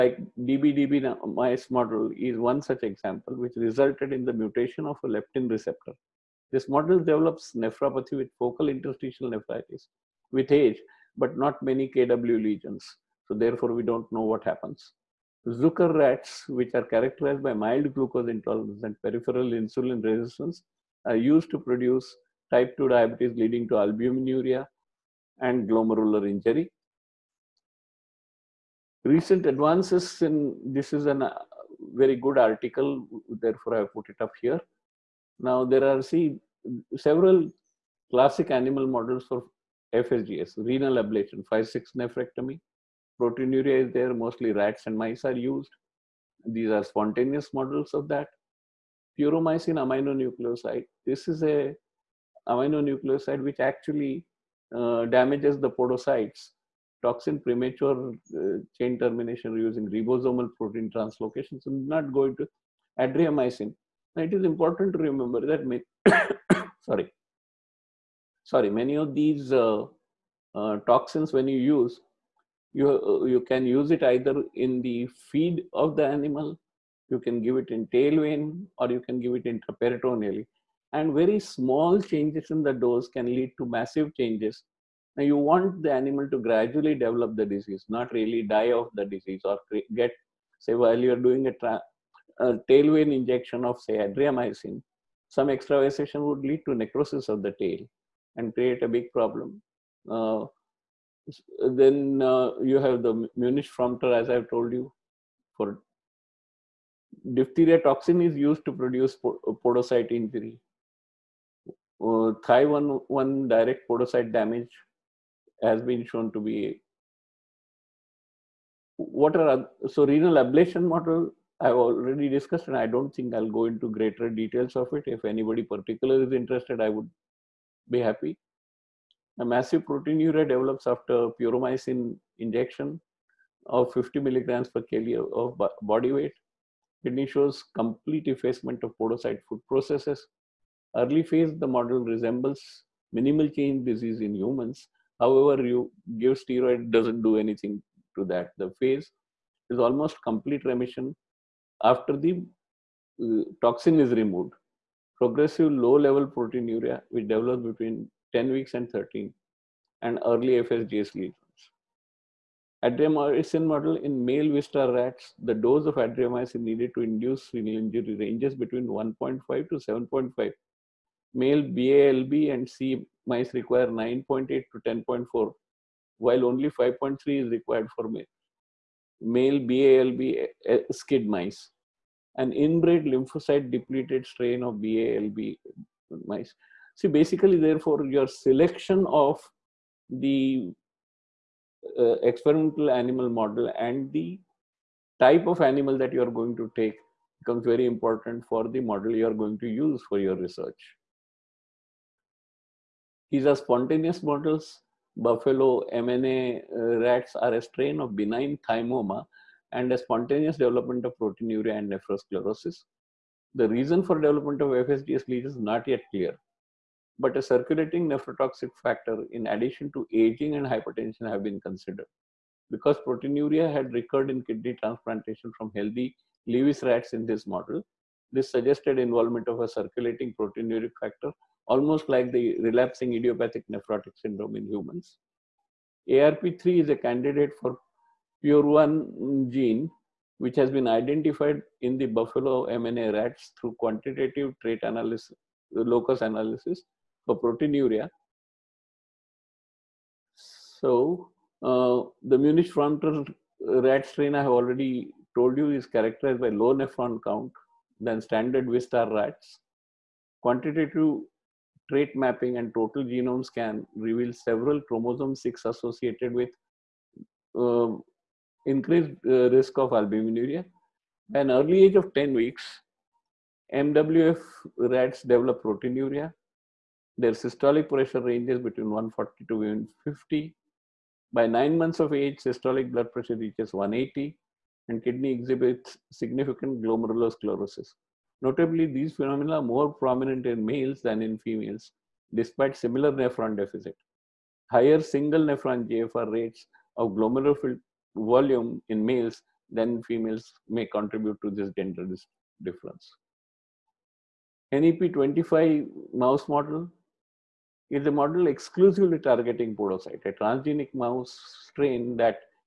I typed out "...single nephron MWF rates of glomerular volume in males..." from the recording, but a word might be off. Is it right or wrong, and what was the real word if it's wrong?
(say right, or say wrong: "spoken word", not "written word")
wrong: "GFR", not "MWF".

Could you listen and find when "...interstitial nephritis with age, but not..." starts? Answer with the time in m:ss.
0:08.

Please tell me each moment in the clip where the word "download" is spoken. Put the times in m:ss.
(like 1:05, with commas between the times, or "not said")
not said.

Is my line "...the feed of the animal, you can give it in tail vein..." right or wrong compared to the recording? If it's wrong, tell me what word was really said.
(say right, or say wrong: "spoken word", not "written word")
right.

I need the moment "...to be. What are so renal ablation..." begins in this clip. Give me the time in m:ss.
1:56.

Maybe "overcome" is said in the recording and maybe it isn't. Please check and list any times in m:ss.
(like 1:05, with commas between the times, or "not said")
not said.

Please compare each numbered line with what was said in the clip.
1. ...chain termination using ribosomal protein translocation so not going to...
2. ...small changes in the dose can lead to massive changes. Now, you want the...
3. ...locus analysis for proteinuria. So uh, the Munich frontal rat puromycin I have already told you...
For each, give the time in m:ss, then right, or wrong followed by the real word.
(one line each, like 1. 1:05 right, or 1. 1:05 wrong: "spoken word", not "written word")
1. 0:58 right
2. 1:21 right
3. 4:05 wrong: "strain", not "puromycin".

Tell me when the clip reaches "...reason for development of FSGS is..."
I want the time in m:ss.
3:33.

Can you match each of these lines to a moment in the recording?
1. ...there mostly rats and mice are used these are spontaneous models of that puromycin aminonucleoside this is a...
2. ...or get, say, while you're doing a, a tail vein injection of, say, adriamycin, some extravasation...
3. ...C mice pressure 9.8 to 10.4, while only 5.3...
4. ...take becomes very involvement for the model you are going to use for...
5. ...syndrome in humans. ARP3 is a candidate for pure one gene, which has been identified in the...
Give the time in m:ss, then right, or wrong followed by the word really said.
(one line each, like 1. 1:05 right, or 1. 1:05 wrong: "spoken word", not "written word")
1. 0:43 right
2. 1:29 right
3. 2:52 wrong: "require", not "pressure"
4. 3:16 wrong: "important", not "involvement"
5. 3:54 right.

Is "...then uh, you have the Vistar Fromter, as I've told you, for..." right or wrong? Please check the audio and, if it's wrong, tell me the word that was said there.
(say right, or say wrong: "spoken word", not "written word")
wrong: "Munich", not "Vistar".